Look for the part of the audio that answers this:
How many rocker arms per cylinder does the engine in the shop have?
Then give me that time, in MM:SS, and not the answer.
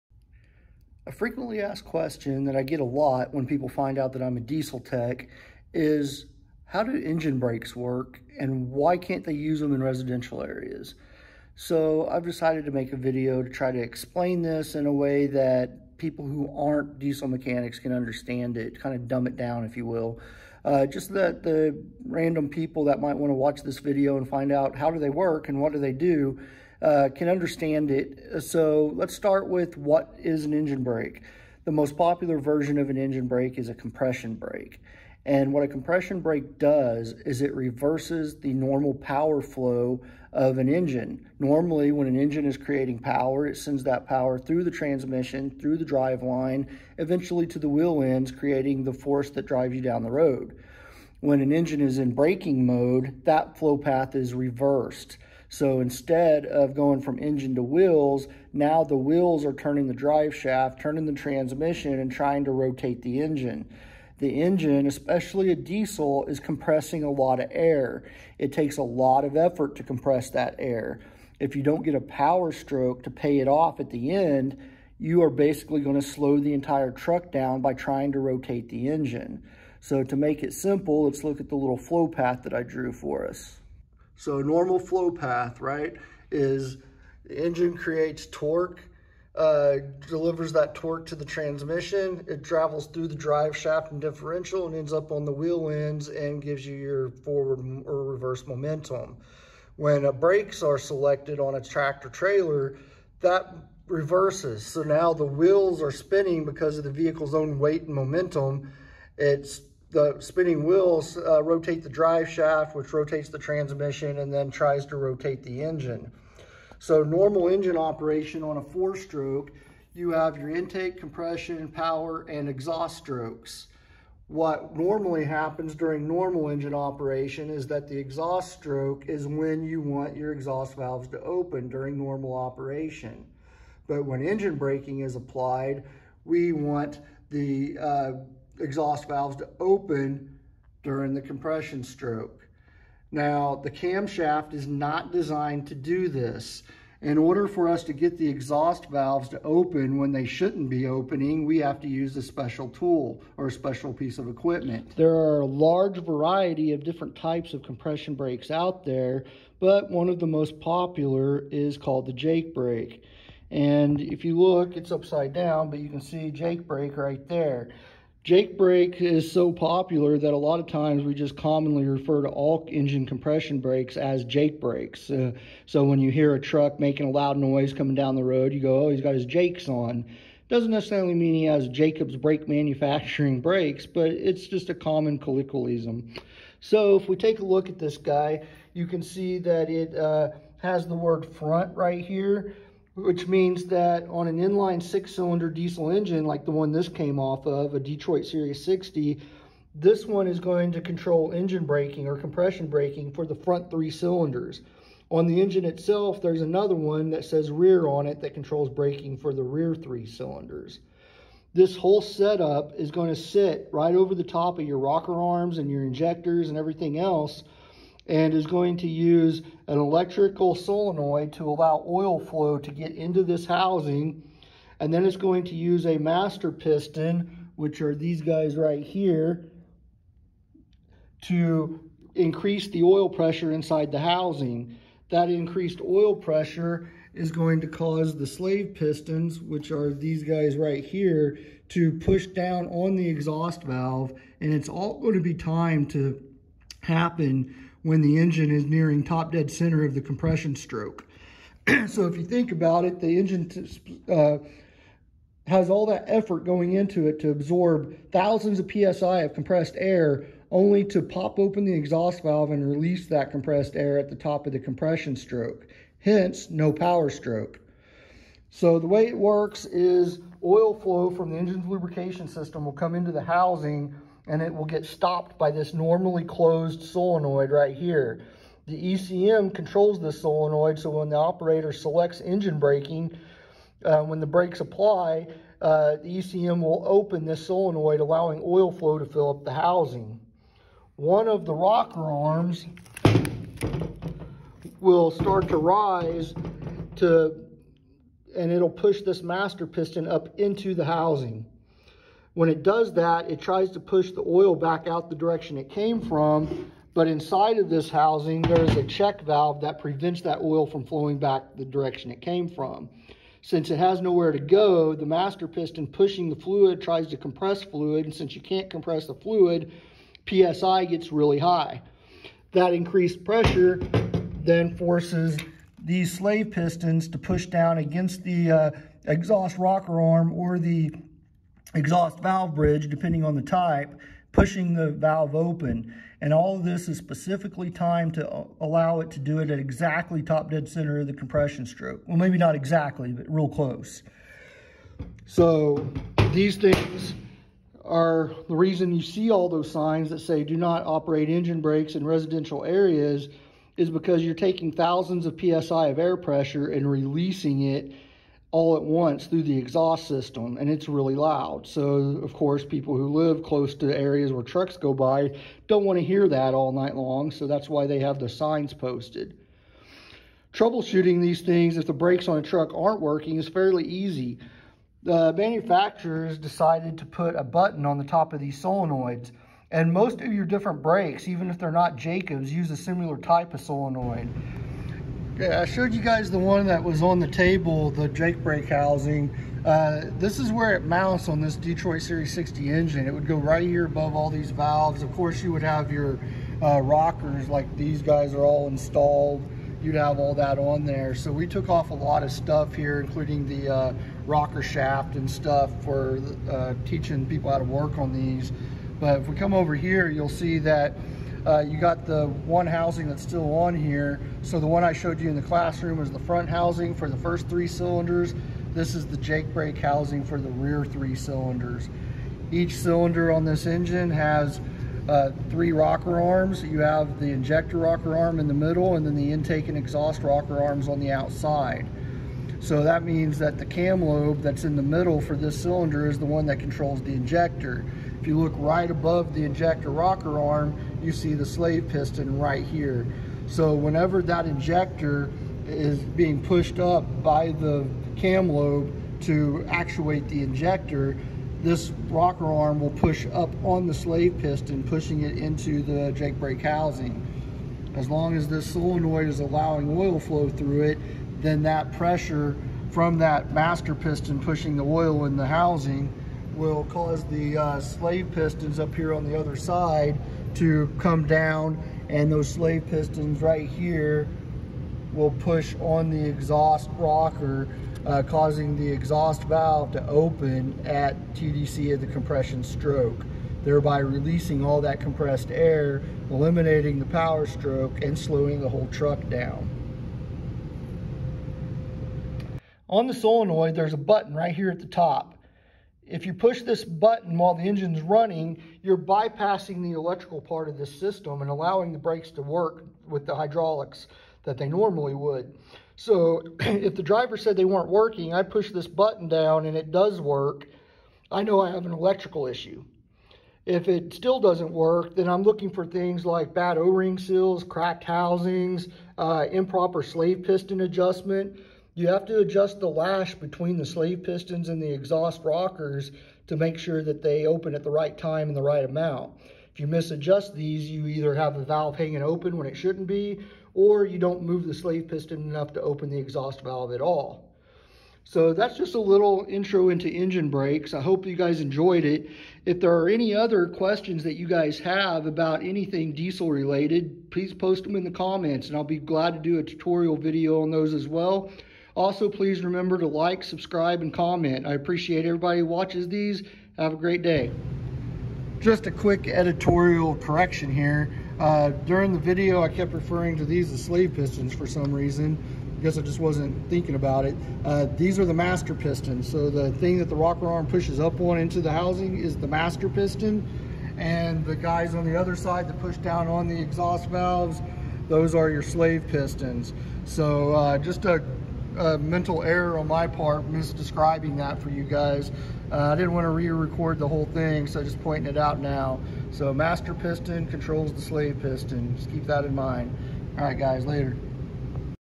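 07:05.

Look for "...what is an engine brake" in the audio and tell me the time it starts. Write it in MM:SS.
00:29.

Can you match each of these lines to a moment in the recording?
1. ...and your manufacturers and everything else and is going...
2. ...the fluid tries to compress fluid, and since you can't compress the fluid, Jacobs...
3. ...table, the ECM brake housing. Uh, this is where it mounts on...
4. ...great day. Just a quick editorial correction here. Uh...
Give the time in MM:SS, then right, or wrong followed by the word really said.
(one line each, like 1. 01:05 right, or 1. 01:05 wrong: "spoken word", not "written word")
1. 03:35 wrong: "injectors", not "manufacturers"
2. 05:16 wrong: "PSI", not "Jacobs"
3. 06:27 wrong: "Jake", not "ECM"
4. 09:16 right.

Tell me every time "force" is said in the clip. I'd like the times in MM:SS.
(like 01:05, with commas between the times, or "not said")
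00:48, 05:24.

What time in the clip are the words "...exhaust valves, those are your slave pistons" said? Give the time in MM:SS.
09:36.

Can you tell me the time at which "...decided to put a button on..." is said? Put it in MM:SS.
06:16.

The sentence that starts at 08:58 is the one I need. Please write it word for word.
So that's just a little intro into engine brakes.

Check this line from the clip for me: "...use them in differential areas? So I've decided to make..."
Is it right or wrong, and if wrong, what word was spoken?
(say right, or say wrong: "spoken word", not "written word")
wrong: "residential", not "differential".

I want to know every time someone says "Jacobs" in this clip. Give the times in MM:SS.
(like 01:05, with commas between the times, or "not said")
03:01, 06:21.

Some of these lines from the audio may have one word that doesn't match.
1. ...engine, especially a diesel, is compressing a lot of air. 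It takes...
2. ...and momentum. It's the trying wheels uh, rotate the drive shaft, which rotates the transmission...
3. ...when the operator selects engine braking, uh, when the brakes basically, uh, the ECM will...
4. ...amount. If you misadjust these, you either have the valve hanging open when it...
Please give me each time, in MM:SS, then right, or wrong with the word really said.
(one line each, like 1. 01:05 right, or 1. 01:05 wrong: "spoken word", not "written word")
1. 01:04 right
2. 01:47 wrong: "spinning", not "trying"
3. 04:40 wrong: "apply", not "basically"
4. 08:48 right.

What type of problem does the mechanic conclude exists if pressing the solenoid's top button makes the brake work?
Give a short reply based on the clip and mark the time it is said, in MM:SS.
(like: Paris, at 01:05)
electrical issue, at 08:31.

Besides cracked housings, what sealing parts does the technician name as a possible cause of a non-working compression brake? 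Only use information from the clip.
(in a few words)
O-ring seals.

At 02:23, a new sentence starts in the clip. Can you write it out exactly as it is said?
Now, the camshaft is not designed to do this.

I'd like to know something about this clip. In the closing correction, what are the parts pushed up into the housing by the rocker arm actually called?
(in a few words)
master pistons.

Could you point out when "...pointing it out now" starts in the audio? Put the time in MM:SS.
09:48.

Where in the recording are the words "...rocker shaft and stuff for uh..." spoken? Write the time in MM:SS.
06:44.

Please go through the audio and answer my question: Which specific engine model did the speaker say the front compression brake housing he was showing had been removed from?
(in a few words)
Detroit Series 60.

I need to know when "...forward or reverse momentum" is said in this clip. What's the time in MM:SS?
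01:37.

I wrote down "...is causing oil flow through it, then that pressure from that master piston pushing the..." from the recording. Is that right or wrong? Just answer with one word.
wrong.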